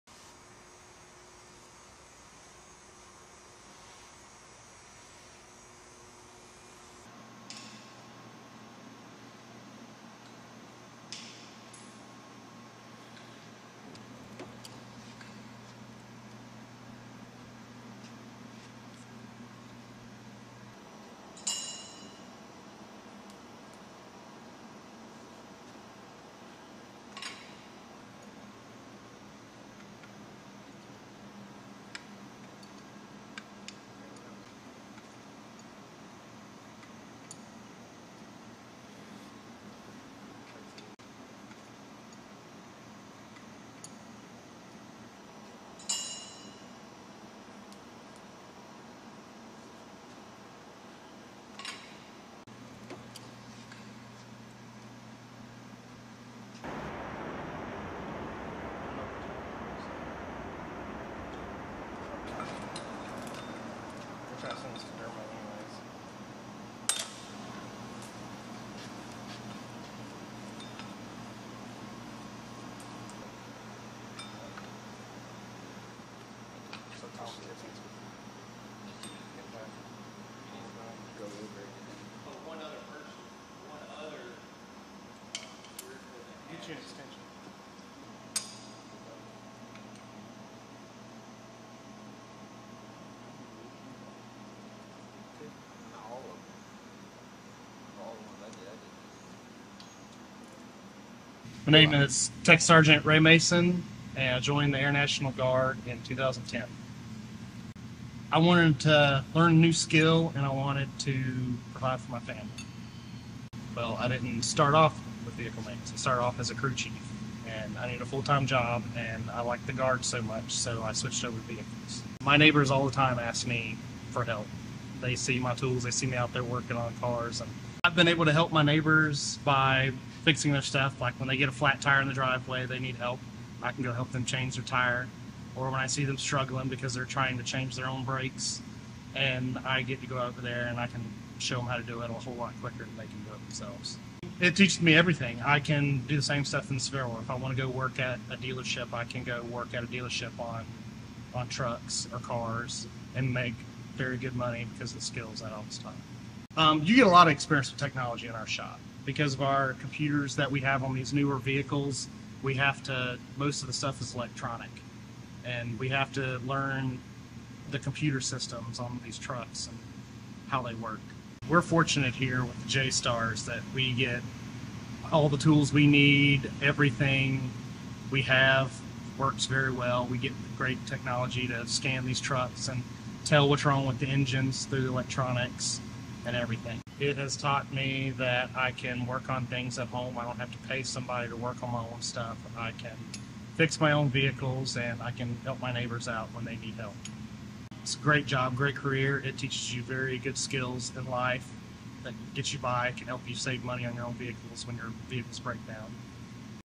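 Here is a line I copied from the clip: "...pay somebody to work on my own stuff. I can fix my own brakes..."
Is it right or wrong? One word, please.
wrong.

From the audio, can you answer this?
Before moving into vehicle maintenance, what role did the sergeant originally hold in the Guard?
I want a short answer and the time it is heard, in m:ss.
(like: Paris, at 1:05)
Crew chief, at 1:56.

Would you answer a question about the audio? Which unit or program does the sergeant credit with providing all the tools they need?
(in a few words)
JSTARS.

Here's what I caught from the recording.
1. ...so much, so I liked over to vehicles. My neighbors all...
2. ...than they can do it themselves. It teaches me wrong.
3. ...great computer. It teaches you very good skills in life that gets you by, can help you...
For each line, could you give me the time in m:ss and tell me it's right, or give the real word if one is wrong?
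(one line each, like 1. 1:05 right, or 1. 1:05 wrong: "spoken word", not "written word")
1. 2:00 wrong: "switched", not "liked"
2. 2:22 wrong: "everything", not "wrong"
3. 3:18 wrong: "career", not "computer".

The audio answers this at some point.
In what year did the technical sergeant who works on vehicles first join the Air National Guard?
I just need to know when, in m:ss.
1:46.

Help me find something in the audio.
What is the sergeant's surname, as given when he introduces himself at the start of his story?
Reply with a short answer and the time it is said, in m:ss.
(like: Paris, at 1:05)
Mason, at 1:43.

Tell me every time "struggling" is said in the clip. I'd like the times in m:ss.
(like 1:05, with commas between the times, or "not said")
2:16.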